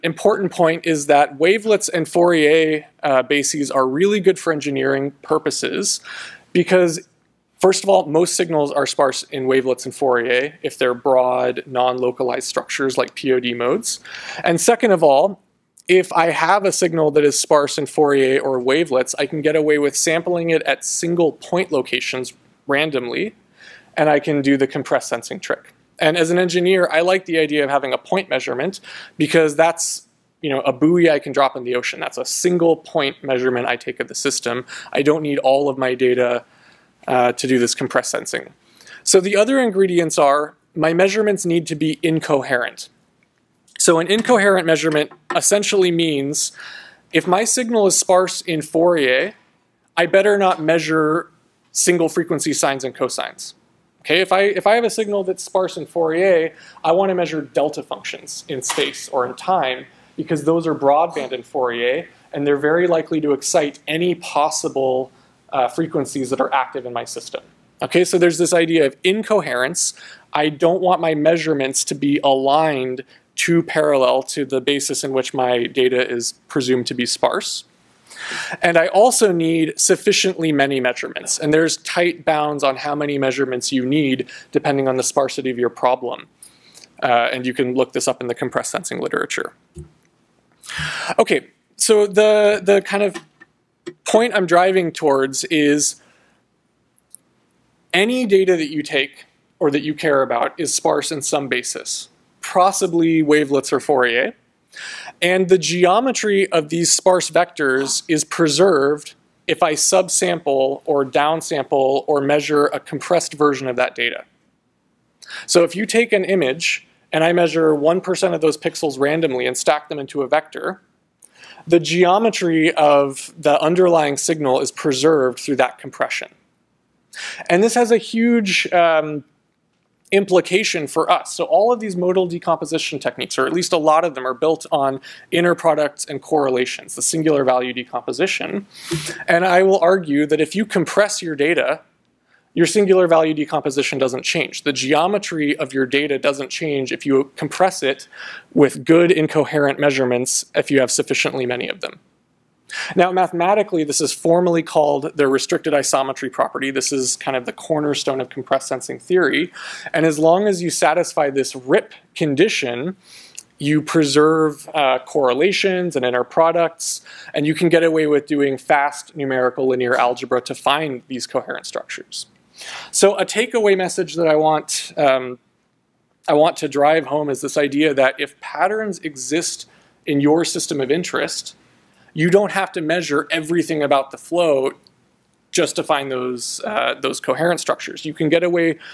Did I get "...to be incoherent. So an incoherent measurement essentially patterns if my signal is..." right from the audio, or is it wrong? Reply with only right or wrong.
wrong.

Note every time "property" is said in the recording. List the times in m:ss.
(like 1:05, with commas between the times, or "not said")
2:36.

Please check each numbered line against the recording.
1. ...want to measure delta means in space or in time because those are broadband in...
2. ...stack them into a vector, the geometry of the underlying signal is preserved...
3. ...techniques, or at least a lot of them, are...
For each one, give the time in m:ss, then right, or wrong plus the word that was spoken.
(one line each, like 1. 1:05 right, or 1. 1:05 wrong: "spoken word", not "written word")
1. 0:56 wrong: "functions", not "means"
2. 1:59 right
3. 2:12 right.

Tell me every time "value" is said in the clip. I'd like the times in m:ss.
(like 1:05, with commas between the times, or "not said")
2:17, 2:23.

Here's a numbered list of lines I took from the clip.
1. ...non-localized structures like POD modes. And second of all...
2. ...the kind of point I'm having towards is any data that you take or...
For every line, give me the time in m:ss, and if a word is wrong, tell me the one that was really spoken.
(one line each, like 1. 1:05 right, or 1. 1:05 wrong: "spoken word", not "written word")
1. 0:11 right
2. 1:32 wrong: "driving", not "having".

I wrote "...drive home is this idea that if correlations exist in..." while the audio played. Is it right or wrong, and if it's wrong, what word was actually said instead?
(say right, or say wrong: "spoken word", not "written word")
wrong: "patterns", not "correlations".